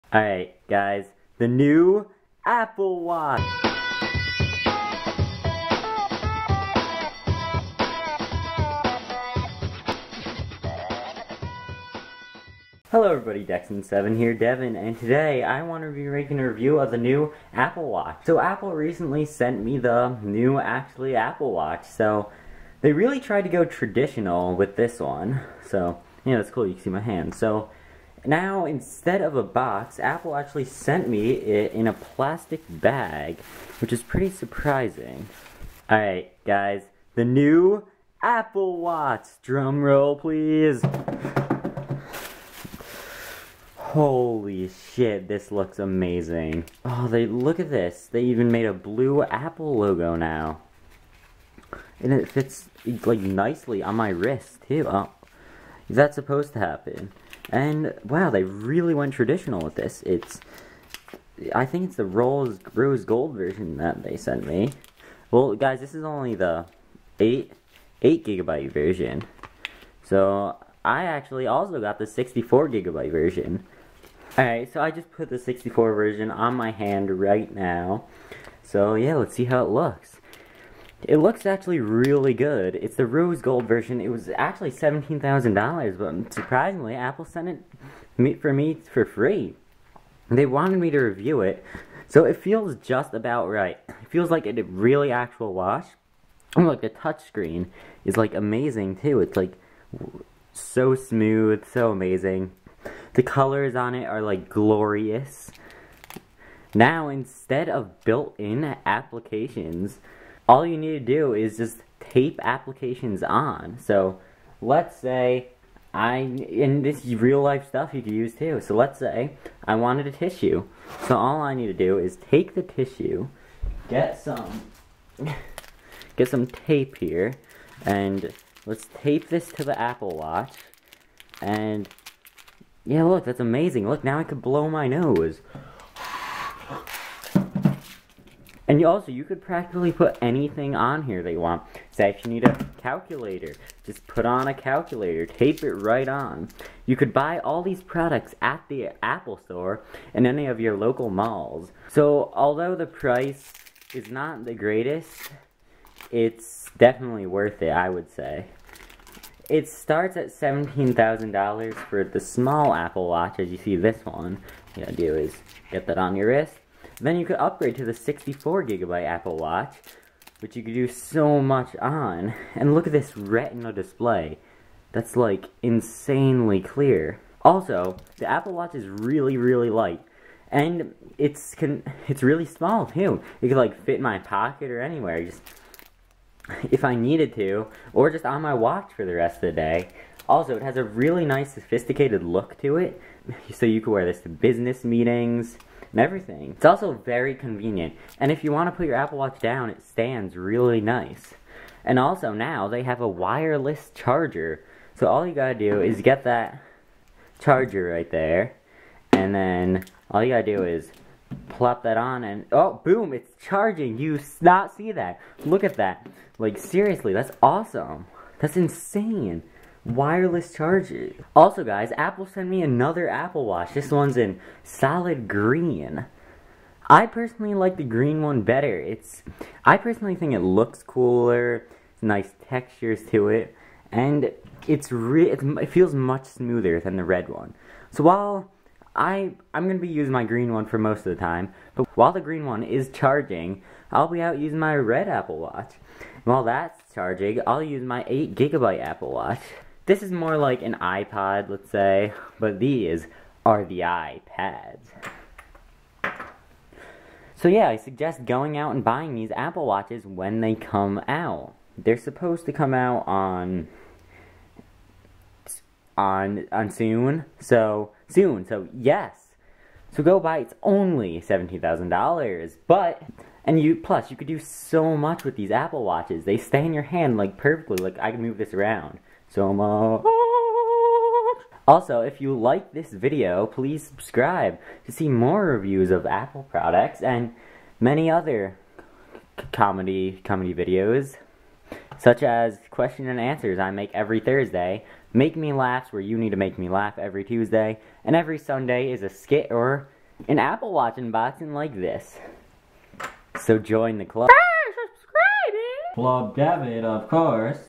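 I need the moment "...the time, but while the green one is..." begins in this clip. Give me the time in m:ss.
4:01.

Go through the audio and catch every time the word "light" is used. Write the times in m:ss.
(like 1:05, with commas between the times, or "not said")
2:59.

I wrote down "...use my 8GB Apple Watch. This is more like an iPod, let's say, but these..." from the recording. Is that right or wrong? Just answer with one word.
right.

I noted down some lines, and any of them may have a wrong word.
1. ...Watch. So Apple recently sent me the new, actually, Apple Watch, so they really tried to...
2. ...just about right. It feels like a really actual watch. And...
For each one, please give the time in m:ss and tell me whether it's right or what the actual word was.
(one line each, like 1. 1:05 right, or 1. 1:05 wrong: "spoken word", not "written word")
1. 0:17 right
2. 1:32 right.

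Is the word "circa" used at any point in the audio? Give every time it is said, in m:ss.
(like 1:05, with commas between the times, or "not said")
not said.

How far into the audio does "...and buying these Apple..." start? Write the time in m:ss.
4:18.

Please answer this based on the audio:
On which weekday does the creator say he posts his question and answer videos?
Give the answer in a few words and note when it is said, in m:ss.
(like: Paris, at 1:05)
Thursday, at 4:54.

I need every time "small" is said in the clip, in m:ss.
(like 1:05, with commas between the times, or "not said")
2:42, 3:02.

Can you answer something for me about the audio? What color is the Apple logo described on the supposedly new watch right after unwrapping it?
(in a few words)
blue.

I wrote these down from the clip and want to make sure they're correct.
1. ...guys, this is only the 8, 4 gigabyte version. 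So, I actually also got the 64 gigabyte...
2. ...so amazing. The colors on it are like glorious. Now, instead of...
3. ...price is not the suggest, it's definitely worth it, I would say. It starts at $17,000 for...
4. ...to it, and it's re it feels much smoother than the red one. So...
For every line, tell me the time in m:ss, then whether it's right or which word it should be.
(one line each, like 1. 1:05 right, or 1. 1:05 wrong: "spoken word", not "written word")
1. 1:05 wrong: "8", not "4"
2. 1:41 right
3. 2:32 wrong: "greatest", not "suggest"
4. 3:53 right.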